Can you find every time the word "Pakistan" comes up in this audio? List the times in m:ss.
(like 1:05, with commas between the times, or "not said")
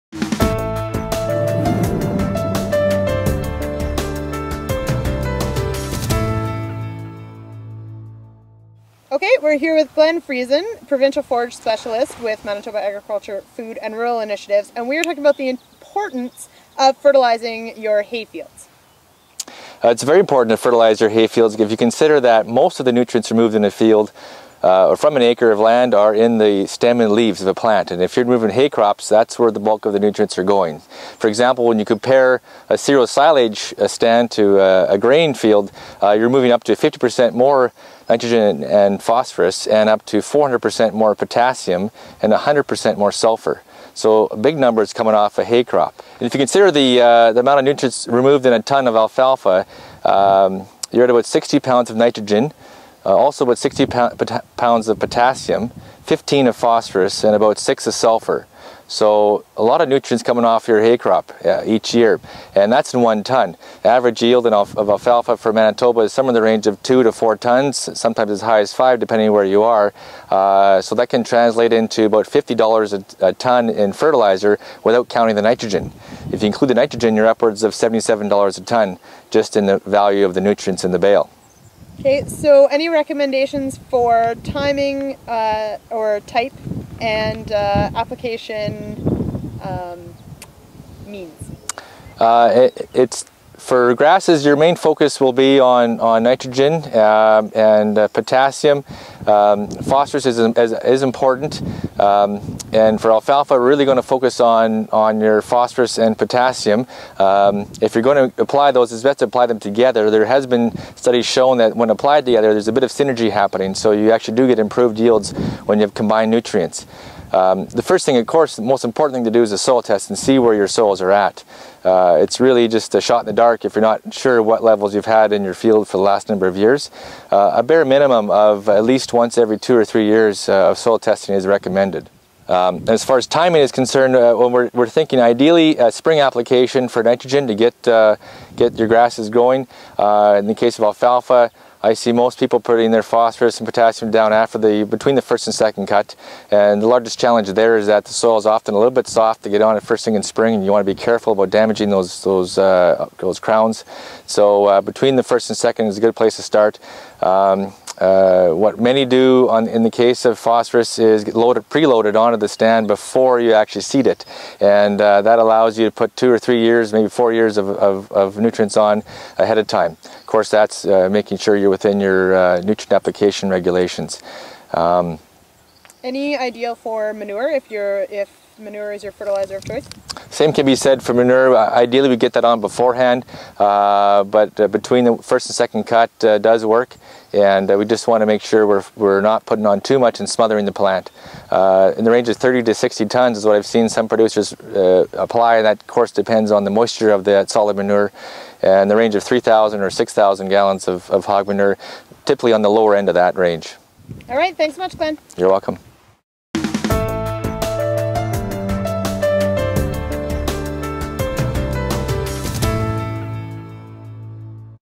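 not said.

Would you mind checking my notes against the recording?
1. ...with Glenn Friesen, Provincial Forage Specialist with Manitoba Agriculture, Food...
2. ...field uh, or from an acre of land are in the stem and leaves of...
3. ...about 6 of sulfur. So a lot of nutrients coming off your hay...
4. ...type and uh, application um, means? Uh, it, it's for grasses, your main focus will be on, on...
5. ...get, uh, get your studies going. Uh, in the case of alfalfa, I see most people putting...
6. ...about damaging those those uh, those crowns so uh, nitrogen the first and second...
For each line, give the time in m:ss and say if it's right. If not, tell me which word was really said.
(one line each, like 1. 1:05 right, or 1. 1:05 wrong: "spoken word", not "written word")
1. 0:09 right
2. 0:23 right
3. 0:57 right
4. 1:26 right
5. 2:17 wrong: "grasses", not "studies"
6. 2:31 wrong: "between", not "nitrogen".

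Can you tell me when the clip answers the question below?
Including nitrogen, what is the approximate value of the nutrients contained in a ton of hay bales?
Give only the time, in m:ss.
1:17.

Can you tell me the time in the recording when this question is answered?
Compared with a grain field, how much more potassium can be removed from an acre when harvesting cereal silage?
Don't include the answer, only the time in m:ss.
0:40.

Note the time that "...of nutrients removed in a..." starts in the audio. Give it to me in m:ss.
0:47.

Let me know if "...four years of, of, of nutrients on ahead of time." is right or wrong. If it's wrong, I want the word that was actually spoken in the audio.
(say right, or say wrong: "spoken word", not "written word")
right.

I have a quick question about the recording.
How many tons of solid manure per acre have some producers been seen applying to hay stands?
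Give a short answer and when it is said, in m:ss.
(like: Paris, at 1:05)
30 to 60 tons, at 3:12.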